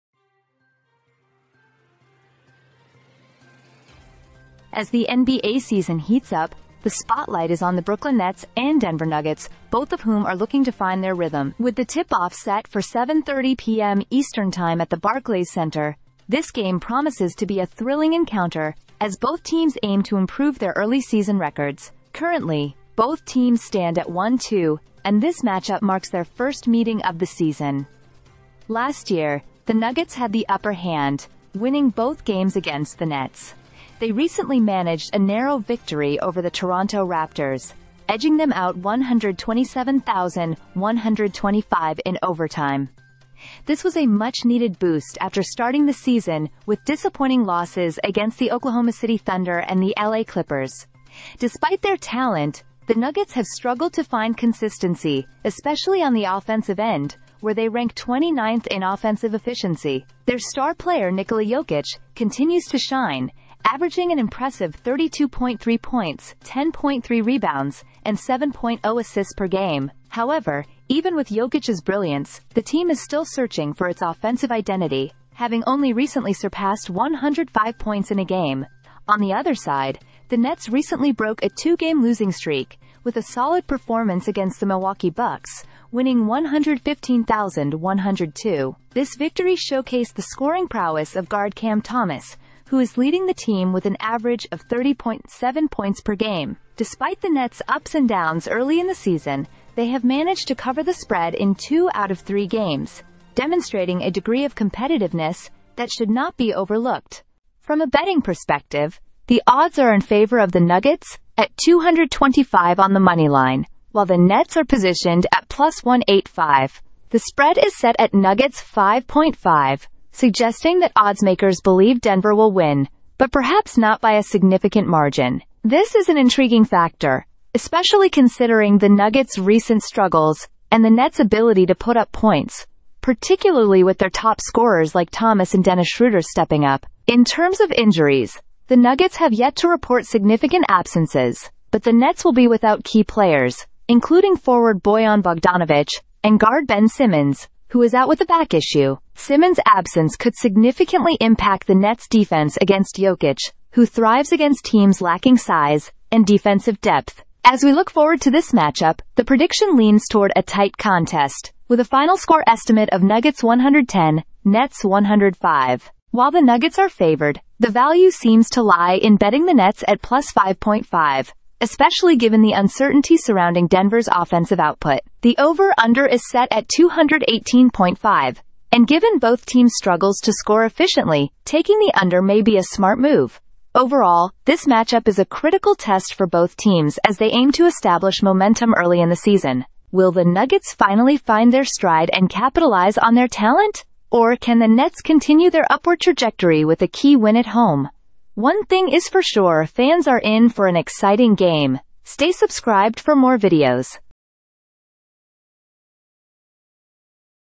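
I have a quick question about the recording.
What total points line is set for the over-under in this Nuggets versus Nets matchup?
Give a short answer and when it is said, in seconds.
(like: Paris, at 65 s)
218.5, at 176 s.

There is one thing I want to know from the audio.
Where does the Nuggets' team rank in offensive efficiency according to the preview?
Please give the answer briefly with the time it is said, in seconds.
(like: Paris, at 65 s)
29th, at 57 s.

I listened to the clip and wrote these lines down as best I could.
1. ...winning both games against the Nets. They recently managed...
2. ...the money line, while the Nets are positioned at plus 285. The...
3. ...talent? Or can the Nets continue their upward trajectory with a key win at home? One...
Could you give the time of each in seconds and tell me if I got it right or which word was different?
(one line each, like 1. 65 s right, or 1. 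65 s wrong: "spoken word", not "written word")
1. 31 s right
2. 112 s wrong: "185", not "285"
3. 193 s right.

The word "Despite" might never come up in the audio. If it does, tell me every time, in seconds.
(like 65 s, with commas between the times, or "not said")
51 s, 96 s.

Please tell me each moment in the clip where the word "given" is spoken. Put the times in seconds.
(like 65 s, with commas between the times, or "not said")
172 s, 178 s.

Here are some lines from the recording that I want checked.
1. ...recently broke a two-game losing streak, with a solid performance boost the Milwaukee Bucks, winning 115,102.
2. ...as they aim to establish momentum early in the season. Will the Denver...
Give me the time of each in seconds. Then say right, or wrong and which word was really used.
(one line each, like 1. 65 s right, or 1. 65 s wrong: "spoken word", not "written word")
1. 80 s wrong: "against", not "boost"
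2. 187 s wrong: "Nuggets", not "Denver".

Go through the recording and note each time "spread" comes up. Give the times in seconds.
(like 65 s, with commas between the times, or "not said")
100 s, 117 s.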